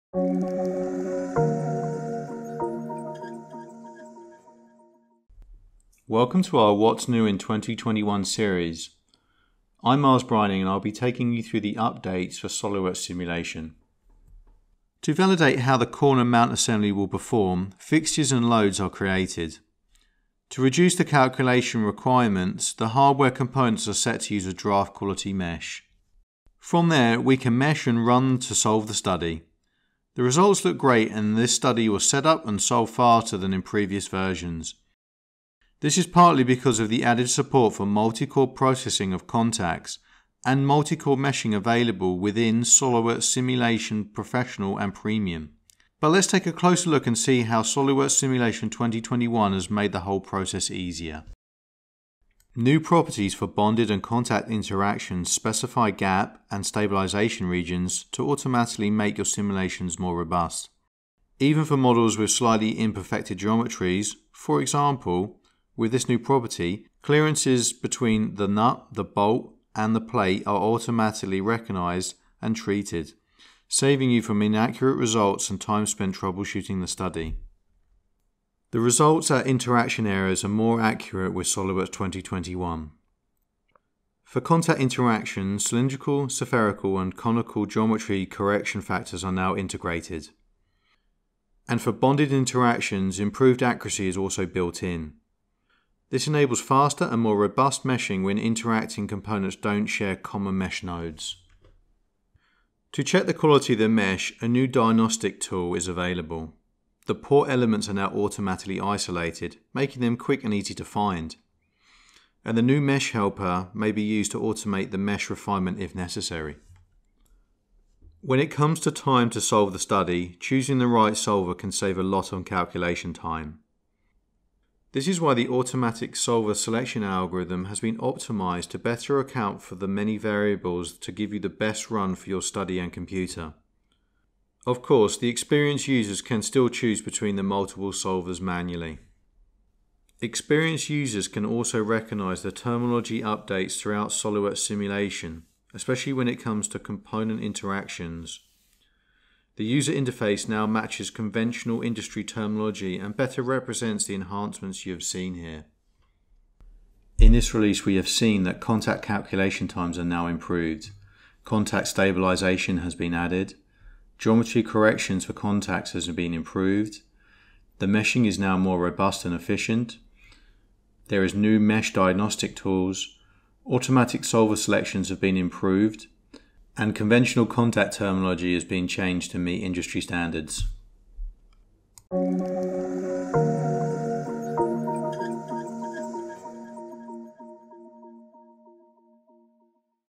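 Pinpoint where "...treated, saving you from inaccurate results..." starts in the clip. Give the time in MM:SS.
01:12.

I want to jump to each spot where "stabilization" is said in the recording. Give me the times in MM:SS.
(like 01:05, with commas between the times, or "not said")
00:56, 02:41.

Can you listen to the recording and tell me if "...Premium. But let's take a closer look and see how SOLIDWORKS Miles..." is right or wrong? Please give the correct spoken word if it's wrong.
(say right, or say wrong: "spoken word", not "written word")
wrong: "Simulation", not "Miles".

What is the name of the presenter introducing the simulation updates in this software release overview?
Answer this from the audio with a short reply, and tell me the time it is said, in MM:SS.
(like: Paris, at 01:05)
Miles Brining, at 00:10.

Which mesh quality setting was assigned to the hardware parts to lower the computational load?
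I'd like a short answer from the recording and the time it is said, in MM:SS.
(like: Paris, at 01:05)
draft quality, at 00:24.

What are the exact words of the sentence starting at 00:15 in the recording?
To validate how the corner mount assembly will perform, fixtures and loads are created.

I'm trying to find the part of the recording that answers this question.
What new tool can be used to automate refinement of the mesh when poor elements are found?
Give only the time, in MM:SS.
01:52.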